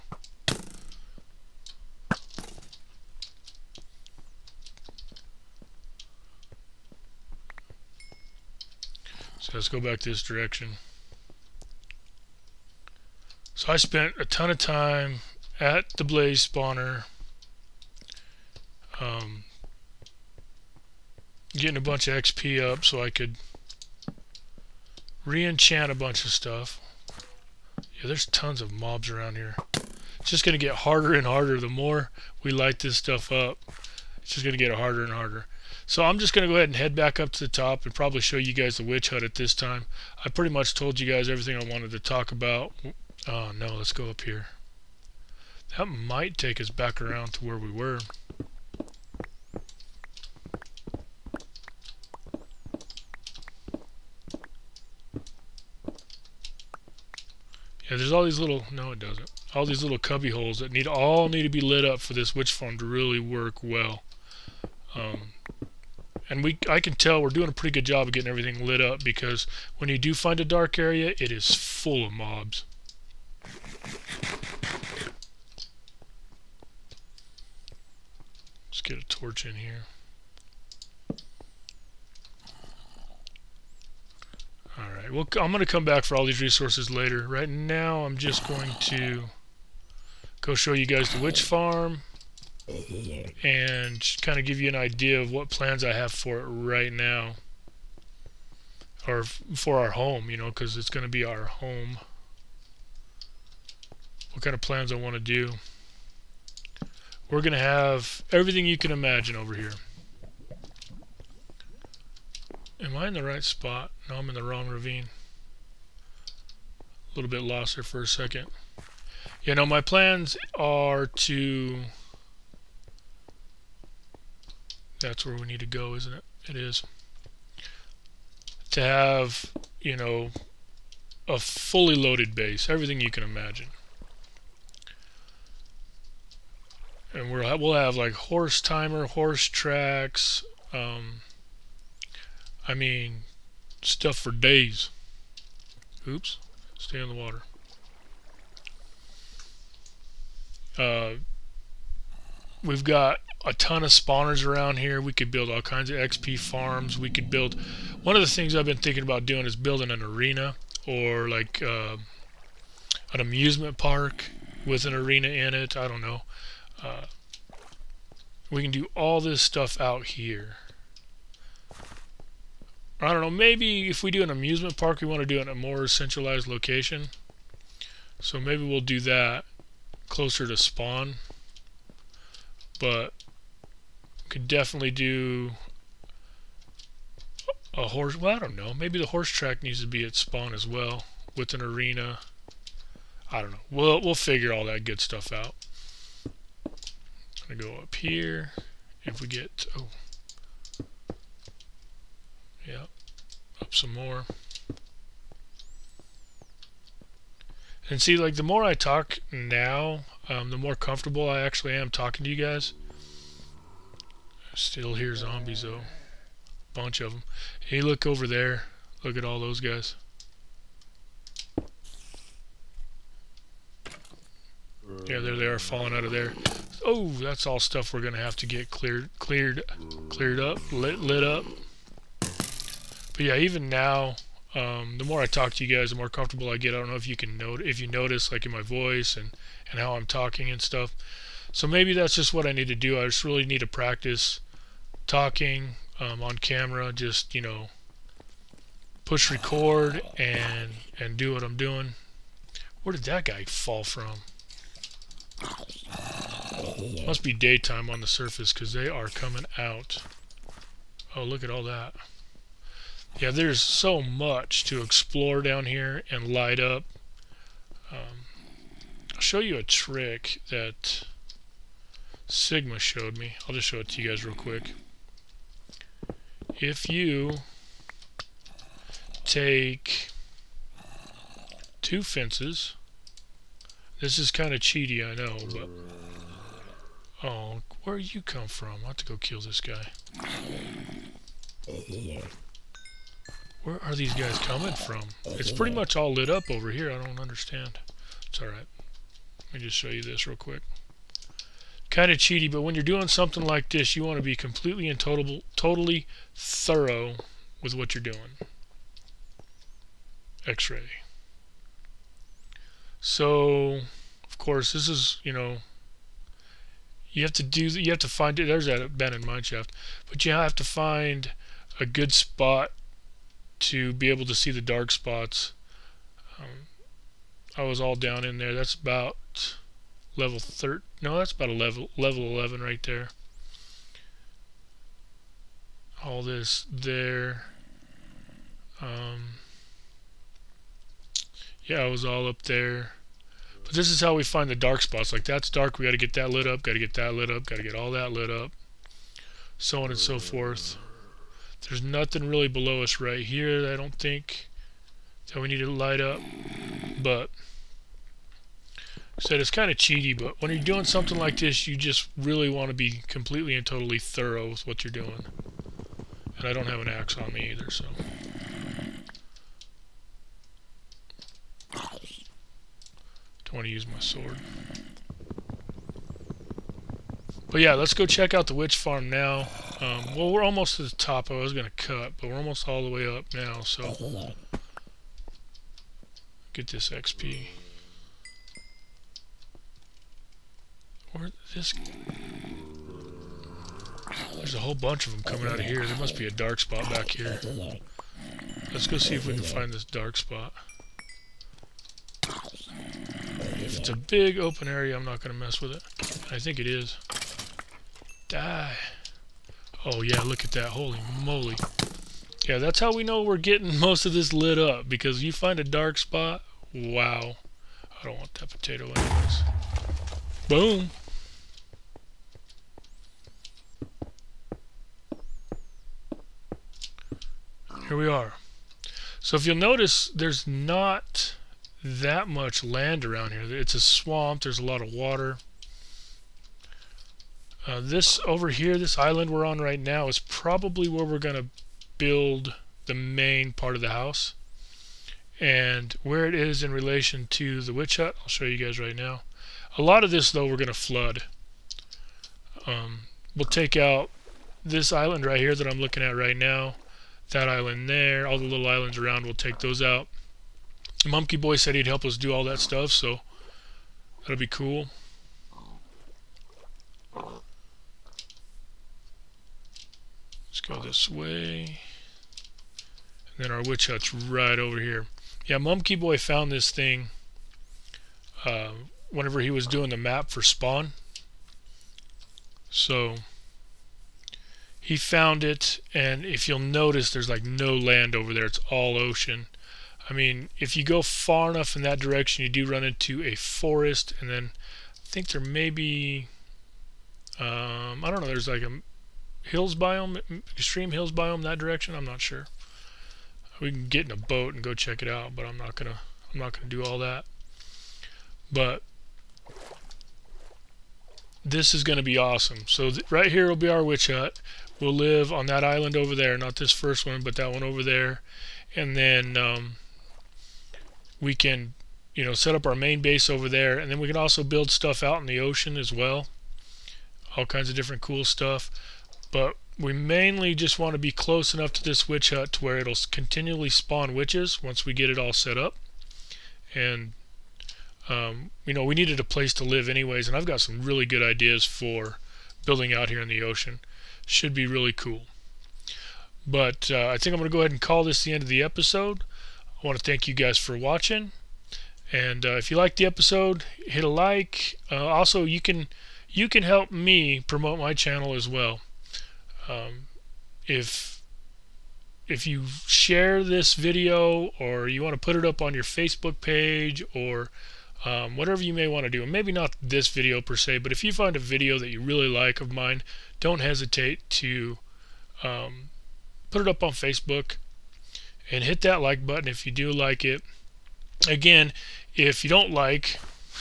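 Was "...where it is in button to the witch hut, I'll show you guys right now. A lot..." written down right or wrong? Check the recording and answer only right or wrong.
wrong.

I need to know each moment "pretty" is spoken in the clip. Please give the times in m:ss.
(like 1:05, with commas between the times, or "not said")
0:40, 1:07, 4:55.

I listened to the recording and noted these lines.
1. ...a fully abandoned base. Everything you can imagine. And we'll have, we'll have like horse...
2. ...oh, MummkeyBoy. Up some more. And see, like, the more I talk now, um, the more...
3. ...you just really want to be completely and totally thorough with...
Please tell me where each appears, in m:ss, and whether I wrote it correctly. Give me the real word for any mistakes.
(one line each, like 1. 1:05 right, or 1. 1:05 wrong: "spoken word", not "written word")
1. 2:11 wrong: "loaded", not "abandoned"
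2. 3:19 wrong: "Yep", not "MummkeyBoy"
3. 6:01 right.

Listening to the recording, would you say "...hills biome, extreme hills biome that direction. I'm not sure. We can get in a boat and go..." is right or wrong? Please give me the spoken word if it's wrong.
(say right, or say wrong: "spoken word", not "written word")
right.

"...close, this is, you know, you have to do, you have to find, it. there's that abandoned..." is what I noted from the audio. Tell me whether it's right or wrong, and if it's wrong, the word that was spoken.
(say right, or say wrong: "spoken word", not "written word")
wrong: "course", not "close".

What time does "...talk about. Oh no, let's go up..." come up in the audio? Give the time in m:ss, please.
0:41.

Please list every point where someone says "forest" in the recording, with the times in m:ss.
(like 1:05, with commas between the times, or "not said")
8:13.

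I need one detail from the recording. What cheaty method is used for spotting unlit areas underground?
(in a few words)
X-ray.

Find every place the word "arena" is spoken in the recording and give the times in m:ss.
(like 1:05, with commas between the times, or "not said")
2:40, 2:44, 3:11.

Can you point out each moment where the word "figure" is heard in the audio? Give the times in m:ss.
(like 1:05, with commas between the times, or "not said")
3:14.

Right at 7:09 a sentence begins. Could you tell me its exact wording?
So if you'll notice, there's not that much land around here.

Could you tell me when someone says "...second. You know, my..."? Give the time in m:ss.
1:58.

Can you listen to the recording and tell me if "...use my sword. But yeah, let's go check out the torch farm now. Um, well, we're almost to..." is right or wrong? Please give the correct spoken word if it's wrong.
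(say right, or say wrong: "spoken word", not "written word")
wrong: "witch", not "torch".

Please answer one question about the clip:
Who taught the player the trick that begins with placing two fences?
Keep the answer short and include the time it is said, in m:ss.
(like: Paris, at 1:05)
Sigma, at 4:32.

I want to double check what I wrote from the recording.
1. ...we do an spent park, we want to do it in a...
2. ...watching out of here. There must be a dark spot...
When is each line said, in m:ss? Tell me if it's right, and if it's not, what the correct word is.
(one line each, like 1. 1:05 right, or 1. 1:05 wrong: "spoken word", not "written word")
1. 2:54 wrong: "amusement", not "spent"
2. 6:35 wrong: "coming", not "watching".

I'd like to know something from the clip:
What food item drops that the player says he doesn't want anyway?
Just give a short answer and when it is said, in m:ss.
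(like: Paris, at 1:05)
Potato, at 6:58.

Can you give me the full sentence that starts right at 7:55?
Yeah, MummkeyBoy found this thing uh, whenever he was doing the map for Spawn.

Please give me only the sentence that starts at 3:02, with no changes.
But could definitely do a horse, well, I don't know.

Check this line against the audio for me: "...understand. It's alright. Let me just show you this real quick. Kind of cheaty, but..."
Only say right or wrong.
right.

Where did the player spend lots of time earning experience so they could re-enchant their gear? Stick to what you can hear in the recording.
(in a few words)
Blaze spawner.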